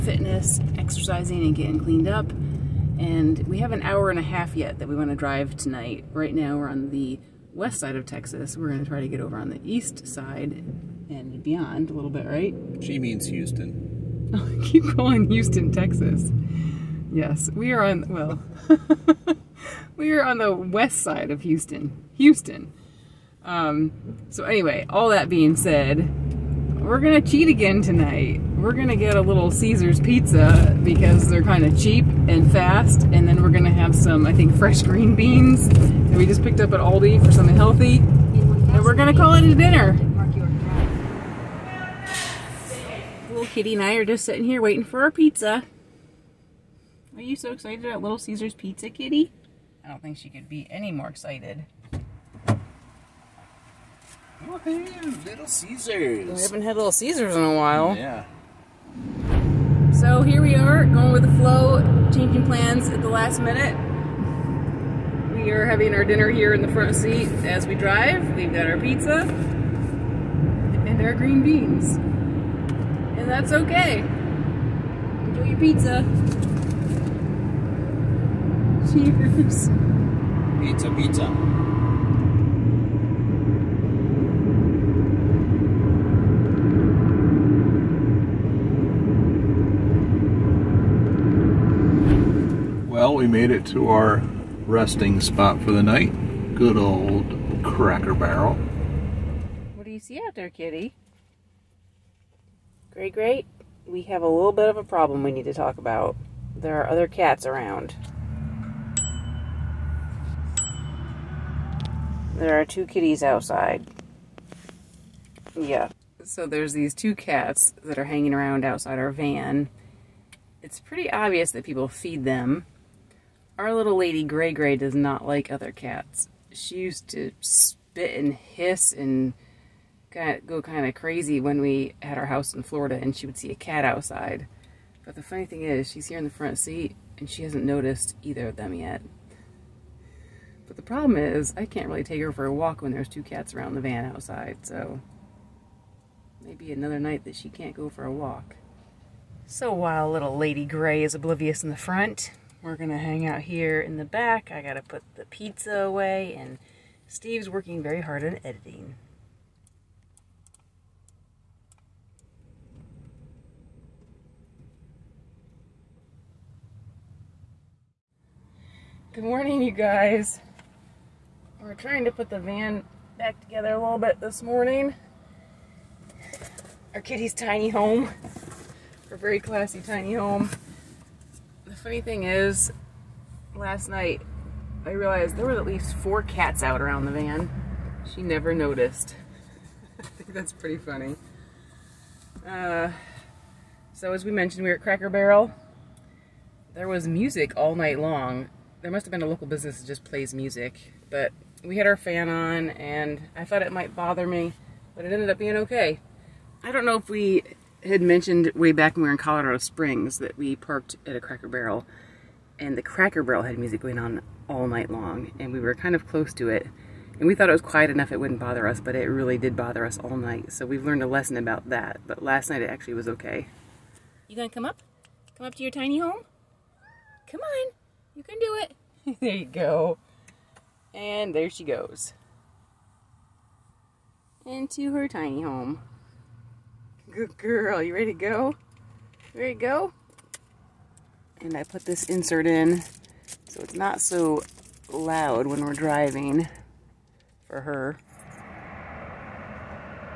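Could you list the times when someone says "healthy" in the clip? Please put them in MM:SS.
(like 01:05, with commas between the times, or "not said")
00:37.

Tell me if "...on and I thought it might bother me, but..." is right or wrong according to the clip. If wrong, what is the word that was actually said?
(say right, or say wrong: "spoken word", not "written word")
right.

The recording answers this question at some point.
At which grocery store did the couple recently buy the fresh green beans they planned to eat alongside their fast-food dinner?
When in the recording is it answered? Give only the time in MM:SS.
00:36.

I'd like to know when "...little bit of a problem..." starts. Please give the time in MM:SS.
01:44.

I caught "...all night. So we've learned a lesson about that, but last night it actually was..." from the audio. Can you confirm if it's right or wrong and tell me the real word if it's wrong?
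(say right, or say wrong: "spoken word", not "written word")
right.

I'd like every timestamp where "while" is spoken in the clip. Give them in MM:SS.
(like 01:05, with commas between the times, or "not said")
00:57, 02:29.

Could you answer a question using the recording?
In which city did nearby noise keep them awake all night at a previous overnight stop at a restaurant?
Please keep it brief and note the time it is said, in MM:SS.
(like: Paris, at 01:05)
Colorado Springs, at 03:29.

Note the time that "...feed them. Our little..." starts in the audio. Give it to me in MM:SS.
02:01.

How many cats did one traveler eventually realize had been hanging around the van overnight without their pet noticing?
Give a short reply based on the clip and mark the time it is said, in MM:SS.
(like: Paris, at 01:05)
at least 4, at 03:05.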